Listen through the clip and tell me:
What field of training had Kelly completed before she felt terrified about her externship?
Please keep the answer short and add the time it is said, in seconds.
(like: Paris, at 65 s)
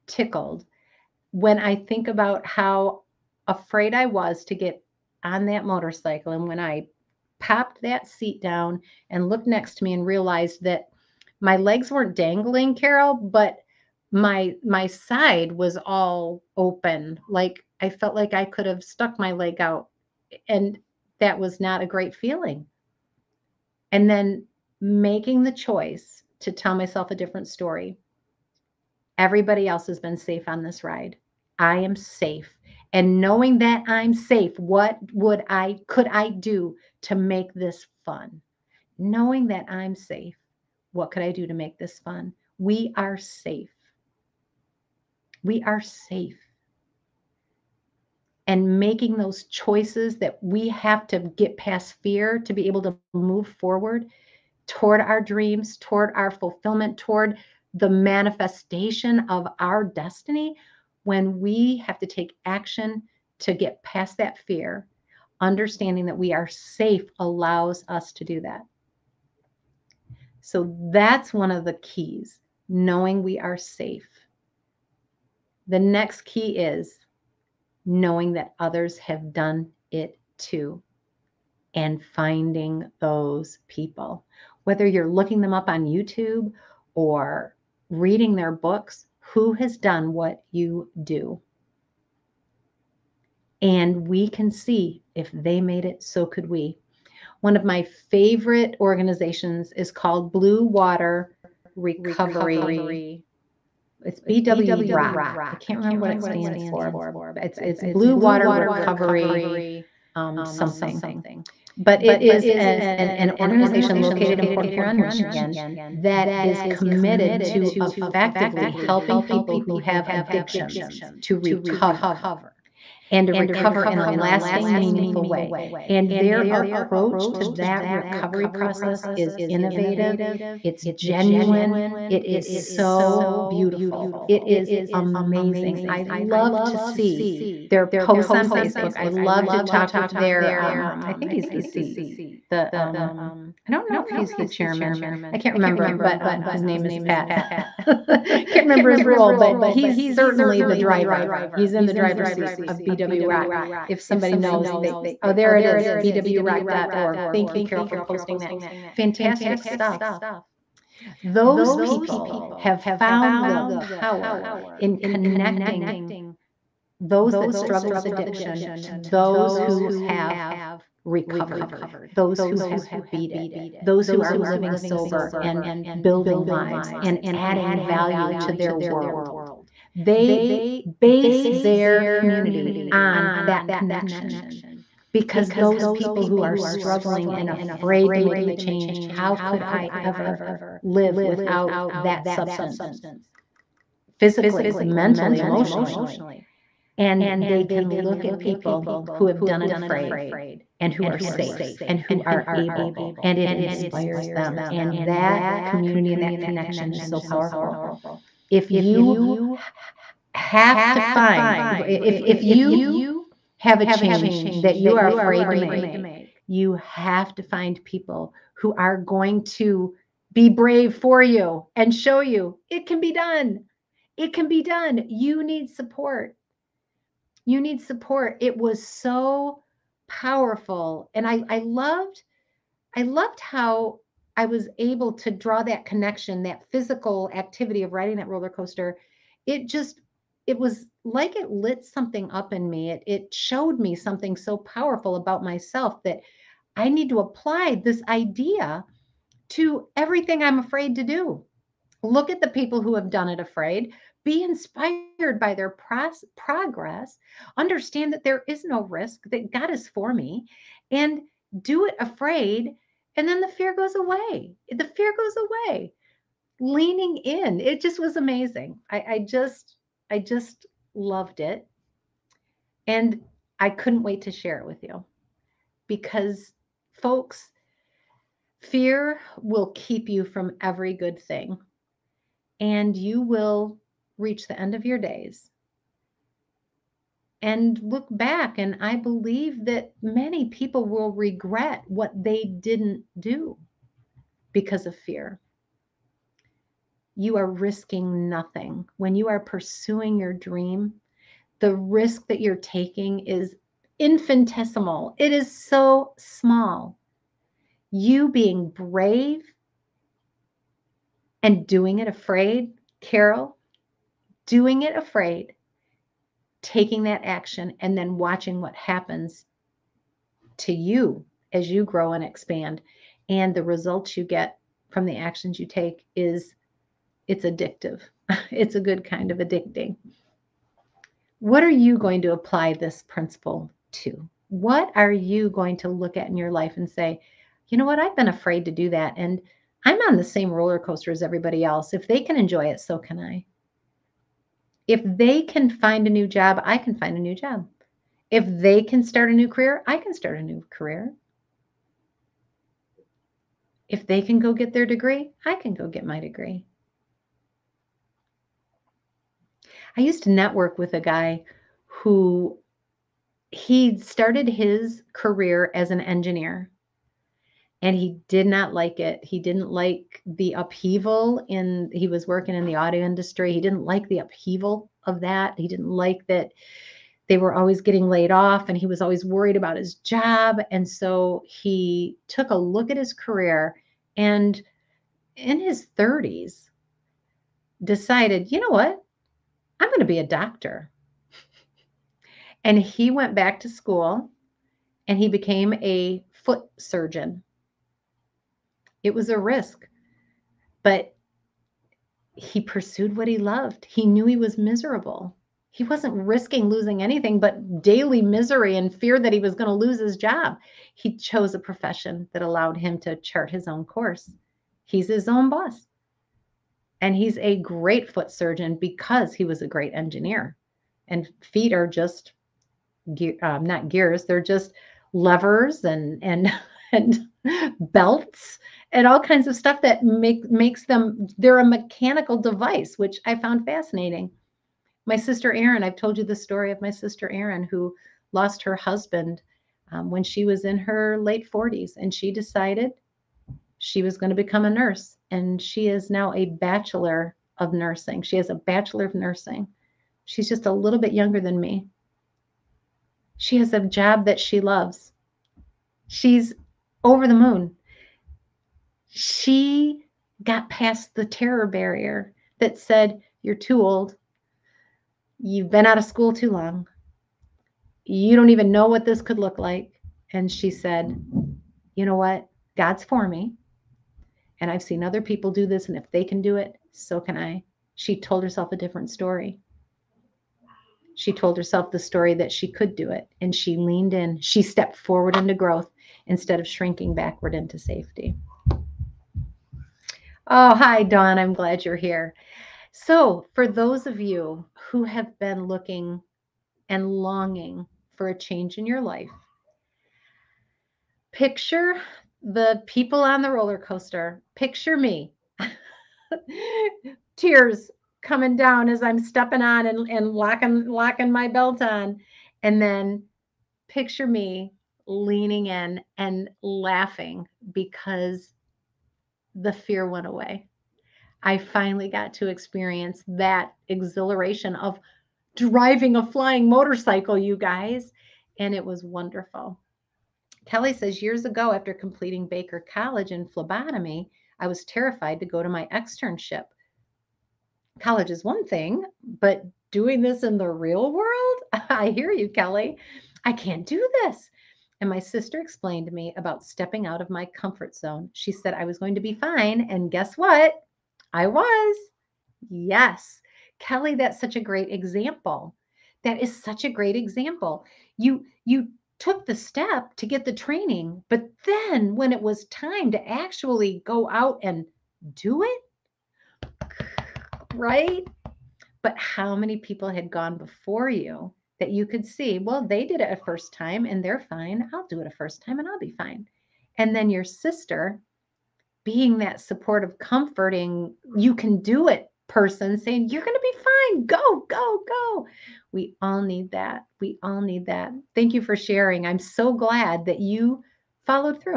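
phlebotomy, at 533 s.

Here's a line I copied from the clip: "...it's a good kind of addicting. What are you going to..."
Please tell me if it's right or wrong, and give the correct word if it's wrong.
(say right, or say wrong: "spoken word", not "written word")
right.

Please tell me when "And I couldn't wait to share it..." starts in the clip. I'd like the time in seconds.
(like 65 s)
272 s.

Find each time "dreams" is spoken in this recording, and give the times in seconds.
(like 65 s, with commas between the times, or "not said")
55 s, 300 s.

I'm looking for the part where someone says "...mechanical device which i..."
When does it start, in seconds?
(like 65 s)
431 s.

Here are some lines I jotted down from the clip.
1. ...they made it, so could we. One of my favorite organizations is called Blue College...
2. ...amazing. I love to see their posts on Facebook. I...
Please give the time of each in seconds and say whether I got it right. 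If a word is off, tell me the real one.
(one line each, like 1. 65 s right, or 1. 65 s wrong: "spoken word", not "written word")
1. 95 s wrong: "Water", not "College"
2. 134 s right.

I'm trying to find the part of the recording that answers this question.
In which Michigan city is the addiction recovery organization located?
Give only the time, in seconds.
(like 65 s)
114 s.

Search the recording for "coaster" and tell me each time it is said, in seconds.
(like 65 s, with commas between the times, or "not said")
238 s, 340 s, 503 s.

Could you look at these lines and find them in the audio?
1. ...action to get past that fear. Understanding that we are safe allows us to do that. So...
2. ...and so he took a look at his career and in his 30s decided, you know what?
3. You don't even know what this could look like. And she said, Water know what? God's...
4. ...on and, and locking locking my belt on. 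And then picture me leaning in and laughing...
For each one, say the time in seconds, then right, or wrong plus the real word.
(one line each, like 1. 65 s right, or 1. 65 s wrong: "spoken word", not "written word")
1. 62 s right
2. 380 s right
3. 468 s wrong: "You", not "Water"
4. 509 s right.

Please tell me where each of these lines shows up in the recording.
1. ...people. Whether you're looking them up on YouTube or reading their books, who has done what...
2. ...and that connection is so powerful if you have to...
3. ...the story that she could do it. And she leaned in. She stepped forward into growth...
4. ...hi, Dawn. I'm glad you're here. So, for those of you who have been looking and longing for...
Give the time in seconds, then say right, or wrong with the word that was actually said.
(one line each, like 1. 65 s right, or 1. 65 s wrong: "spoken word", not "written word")
1. 83 s right
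2. 206 s right
3. 481 s right
4. 490 s right.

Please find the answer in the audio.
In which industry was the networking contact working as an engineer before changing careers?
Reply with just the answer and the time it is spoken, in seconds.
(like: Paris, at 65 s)
auto industry, at 372 s.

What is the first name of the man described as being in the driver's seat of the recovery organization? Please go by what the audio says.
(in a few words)
Pat.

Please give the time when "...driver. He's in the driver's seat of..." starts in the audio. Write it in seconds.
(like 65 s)
150 s.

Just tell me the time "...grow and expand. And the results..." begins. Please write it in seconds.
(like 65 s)
321 s.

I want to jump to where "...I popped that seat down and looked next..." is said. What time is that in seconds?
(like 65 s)
6 s.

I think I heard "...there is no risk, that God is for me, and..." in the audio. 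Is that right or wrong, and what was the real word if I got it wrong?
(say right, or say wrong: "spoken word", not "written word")
right.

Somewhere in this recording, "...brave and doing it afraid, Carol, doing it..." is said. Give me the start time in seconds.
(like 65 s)
308 s.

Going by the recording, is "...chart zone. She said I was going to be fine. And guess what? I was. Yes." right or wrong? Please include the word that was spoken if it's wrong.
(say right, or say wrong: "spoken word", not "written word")
wrong: "comfort", not "chart".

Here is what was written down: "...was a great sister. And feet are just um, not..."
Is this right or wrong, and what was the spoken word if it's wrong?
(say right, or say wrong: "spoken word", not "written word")
wrong: "engineer", not "sister".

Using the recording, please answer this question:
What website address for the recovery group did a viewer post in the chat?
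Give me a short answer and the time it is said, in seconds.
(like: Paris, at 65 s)
bwrock.org, at 155 s.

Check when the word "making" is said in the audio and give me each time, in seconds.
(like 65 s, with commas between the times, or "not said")
24 s, 48 s.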